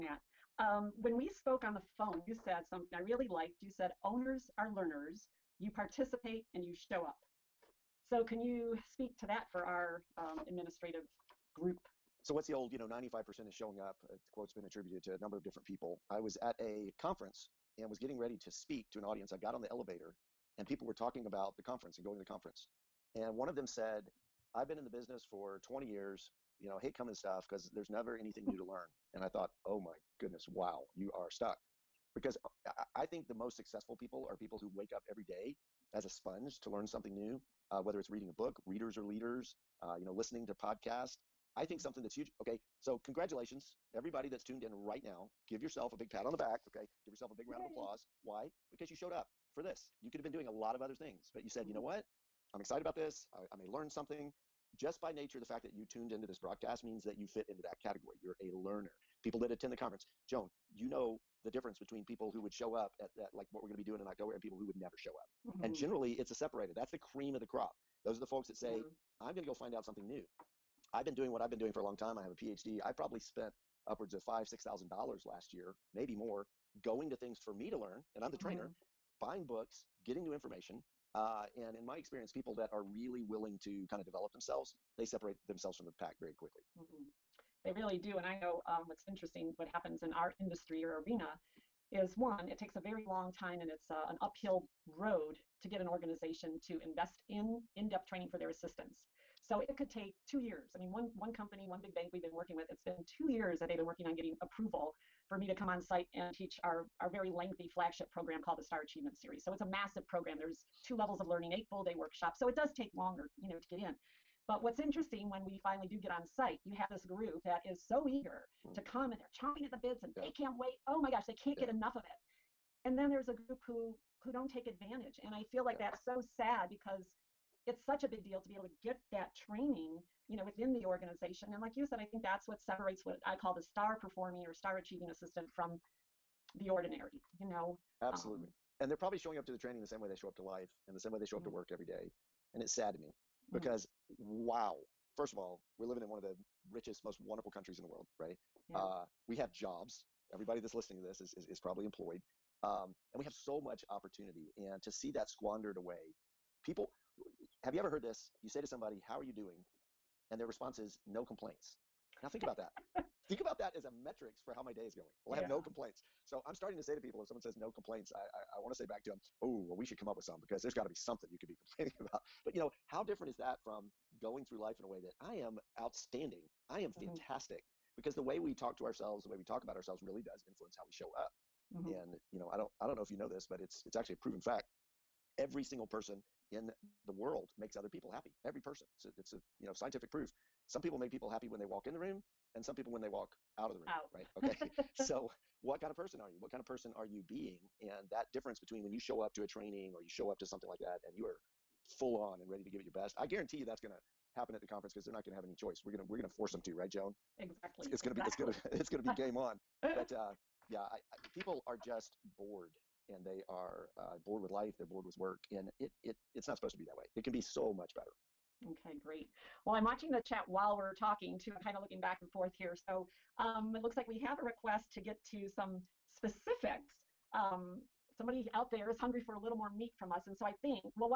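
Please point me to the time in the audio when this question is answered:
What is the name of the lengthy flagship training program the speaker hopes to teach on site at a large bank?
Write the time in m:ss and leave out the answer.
1:48.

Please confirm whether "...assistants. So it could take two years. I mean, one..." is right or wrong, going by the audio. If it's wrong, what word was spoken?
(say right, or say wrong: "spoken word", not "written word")
right.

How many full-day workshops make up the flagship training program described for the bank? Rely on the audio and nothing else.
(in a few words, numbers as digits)
8.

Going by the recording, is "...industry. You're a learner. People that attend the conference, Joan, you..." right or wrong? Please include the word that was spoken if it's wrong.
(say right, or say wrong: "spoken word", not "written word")
wrong: "category", not "industry".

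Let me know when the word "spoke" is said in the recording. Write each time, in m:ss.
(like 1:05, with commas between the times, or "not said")
0:01.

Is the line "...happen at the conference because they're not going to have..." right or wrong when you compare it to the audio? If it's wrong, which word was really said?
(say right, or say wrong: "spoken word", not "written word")
right.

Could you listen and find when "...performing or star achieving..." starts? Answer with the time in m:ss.
2:13.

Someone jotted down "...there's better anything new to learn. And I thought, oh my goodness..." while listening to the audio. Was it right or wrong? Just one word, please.
wrong.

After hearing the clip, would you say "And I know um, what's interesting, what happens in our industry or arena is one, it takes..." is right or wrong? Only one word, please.
right.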